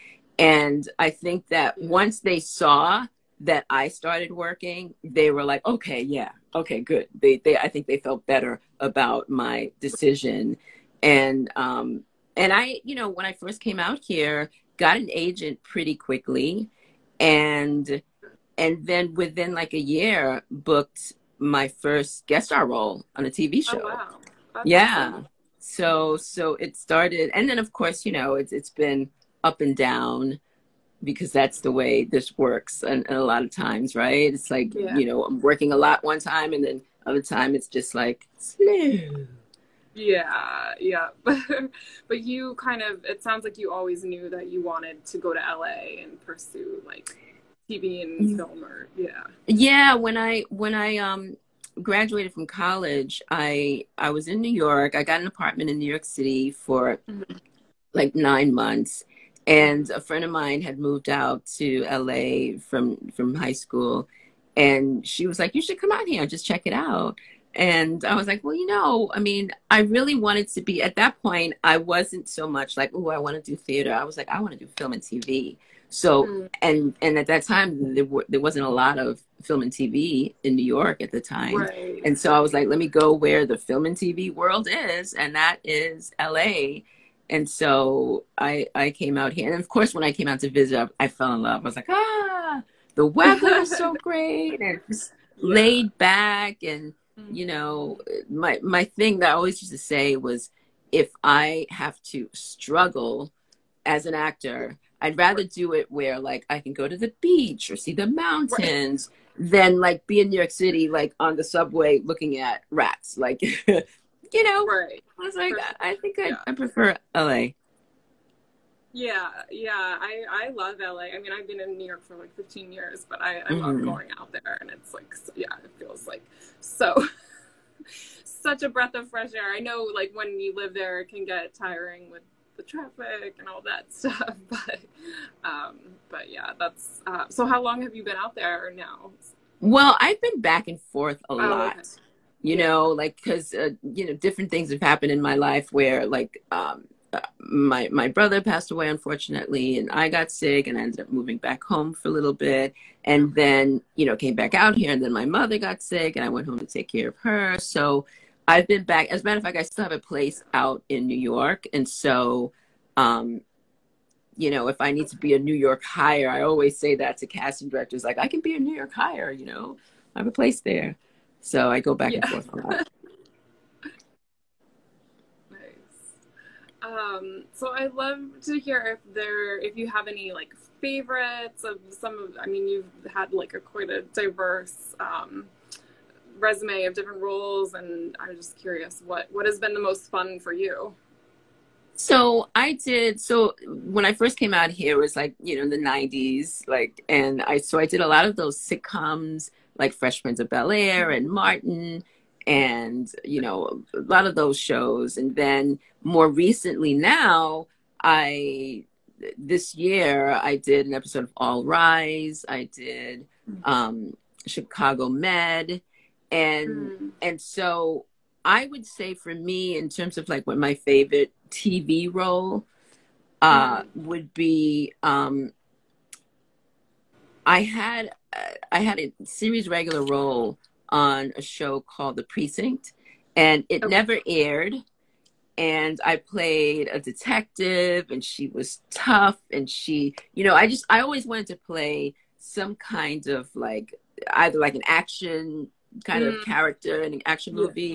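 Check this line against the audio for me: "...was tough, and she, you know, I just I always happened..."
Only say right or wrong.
wrong.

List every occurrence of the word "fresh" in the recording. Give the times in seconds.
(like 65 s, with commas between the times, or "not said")
129 s, 199 s.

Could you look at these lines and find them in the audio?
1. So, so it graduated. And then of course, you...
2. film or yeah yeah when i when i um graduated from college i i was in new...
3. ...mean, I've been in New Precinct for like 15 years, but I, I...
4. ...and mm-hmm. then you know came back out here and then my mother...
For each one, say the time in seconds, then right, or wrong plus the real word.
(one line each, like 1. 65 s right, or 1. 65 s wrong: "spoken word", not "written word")
1. 25 s wrong: "started", not "graduated"
2. 48 s right
3. 121 s wrong: "York", not "Precinct"
4. 153 s right.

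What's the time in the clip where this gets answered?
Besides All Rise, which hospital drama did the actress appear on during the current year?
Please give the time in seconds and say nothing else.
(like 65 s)
214 s.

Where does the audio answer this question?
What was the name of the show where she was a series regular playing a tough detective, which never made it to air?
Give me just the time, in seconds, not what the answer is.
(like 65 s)
232 s.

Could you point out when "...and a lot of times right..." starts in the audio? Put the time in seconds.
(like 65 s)
33 s.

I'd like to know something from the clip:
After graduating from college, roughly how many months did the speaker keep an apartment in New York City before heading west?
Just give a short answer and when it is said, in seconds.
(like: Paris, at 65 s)
9, at 58 s.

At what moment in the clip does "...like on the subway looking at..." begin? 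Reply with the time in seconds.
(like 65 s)
110 s.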